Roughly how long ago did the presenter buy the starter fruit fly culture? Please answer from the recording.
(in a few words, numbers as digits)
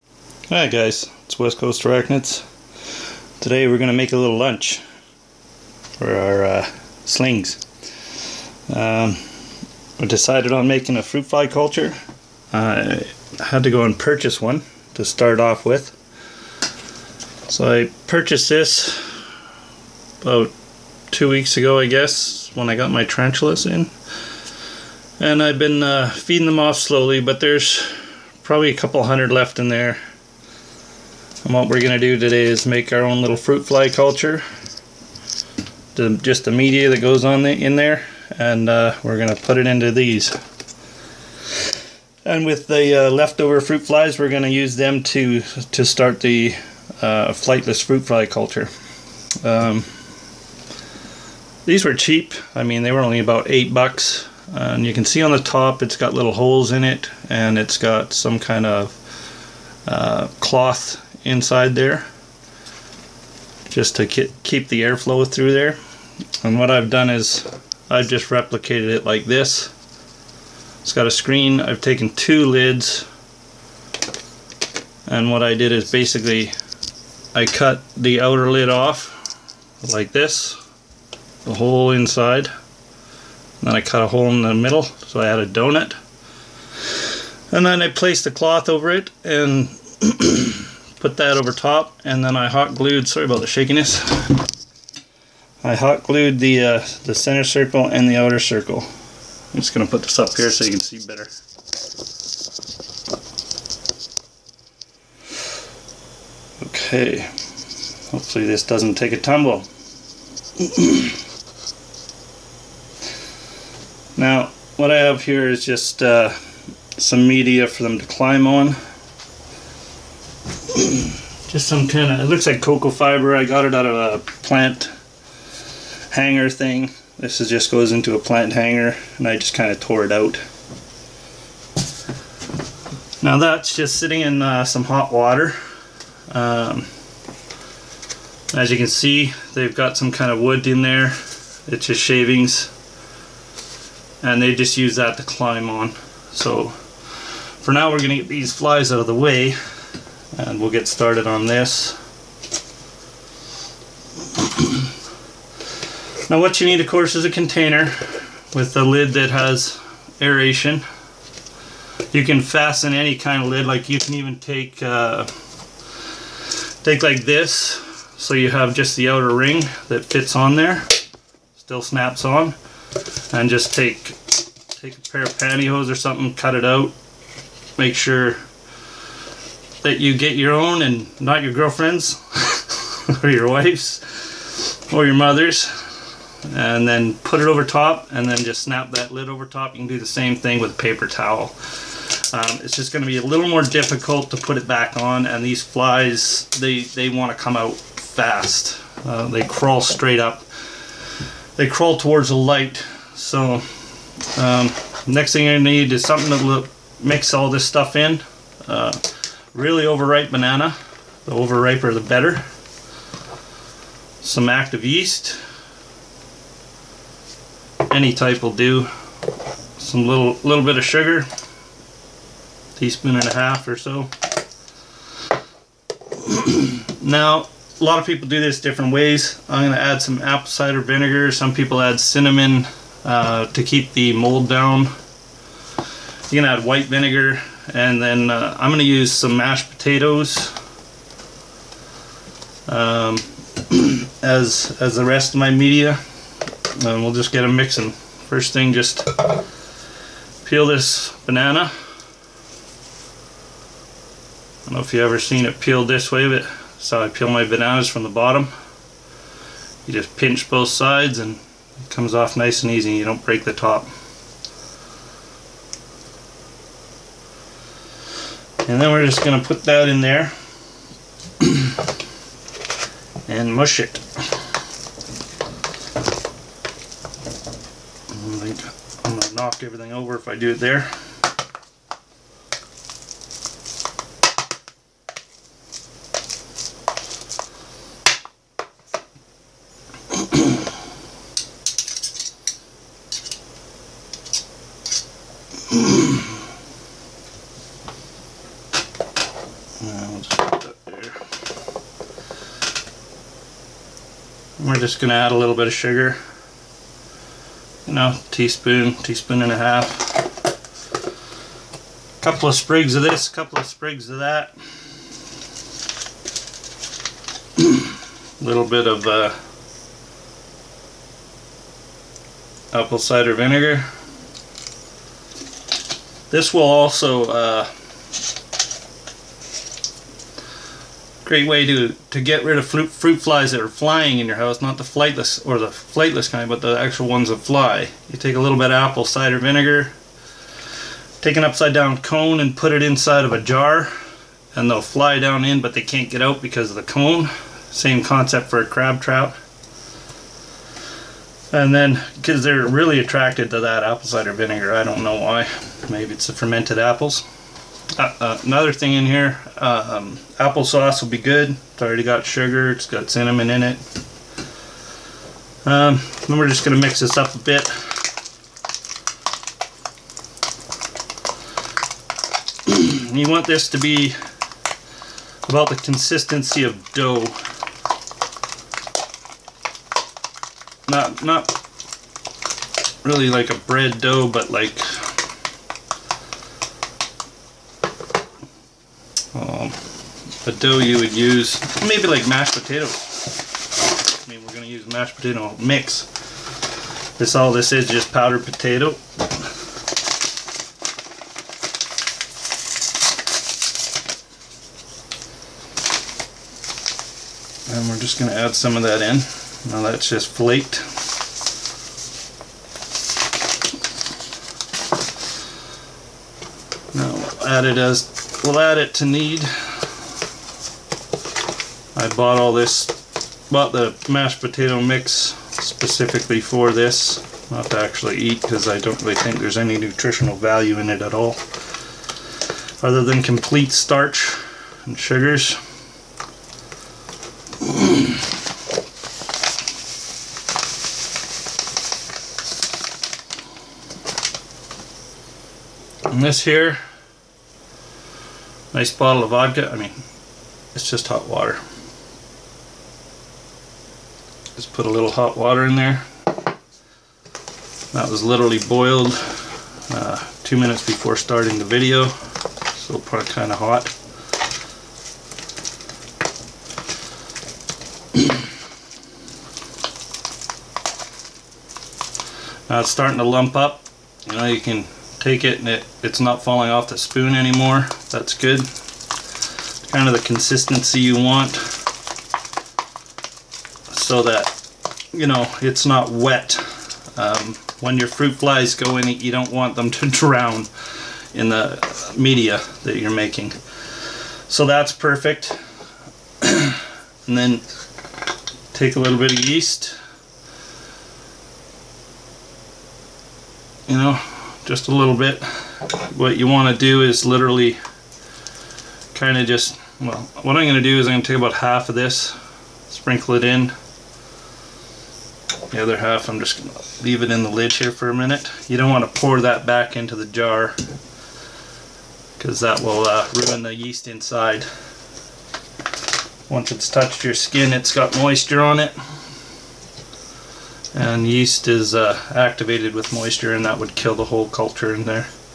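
two weeks.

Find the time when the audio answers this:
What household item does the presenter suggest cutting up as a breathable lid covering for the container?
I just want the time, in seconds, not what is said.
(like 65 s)
175 s.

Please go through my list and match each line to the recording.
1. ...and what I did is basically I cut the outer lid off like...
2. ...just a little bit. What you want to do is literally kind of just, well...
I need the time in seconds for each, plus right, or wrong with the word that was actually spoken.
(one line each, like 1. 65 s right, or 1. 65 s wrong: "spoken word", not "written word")
1. 75 s right
2. 504 s right.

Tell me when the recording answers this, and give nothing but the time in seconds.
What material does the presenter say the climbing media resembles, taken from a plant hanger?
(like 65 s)
122 s.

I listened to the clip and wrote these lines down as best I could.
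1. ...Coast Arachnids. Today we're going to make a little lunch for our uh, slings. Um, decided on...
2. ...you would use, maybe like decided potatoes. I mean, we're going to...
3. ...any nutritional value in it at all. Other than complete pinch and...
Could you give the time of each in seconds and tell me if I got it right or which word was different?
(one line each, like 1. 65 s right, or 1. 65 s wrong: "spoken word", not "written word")
1. 1 s right
2. 390 s wrong: "mashed", not "decided"
3. 429 s wrong: "starch", not "pinch".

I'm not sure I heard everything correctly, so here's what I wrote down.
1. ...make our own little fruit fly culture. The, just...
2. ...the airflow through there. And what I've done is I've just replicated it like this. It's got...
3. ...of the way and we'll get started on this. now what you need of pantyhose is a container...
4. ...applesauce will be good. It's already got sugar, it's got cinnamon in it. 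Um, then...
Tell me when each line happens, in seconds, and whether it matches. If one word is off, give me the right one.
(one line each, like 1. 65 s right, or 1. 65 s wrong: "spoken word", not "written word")
1. 32 s right
2. 64 s right
3. 148 s wrong: "course", not "pantyhose"
4. 360 s right.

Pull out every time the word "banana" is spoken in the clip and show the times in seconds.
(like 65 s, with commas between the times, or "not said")
210 s, 251 s, 257 s.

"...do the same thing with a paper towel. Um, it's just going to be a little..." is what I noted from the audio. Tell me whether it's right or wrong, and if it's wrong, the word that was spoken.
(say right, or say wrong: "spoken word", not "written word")
right.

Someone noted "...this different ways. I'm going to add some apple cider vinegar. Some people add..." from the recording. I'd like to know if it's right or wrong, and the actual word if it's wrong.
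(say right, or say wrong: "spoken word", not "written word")
right.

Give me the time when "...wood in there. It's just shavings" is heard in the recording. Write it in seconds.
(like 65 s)
140 s.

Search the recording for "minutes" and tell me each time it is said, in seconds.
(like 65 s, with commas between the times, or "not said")
460 s, 518 s.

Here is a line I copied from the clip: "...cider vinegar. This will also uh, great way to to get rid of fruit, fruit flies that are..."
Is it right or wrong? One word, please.
right.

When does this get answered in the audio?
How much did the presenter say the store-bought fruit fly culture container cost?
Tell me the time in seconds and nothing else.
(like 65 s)
53 s.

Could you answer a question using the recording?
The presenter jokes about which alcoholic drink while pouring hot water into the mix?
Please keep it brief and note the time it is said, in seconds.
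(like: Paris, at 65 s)
vodka, at 449 s.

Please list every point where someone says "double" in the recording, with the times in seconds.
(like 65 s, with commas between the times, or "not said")
not said.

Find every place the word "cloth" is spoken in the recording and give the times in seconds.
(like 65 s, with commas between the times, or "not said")
60 s, 88 s.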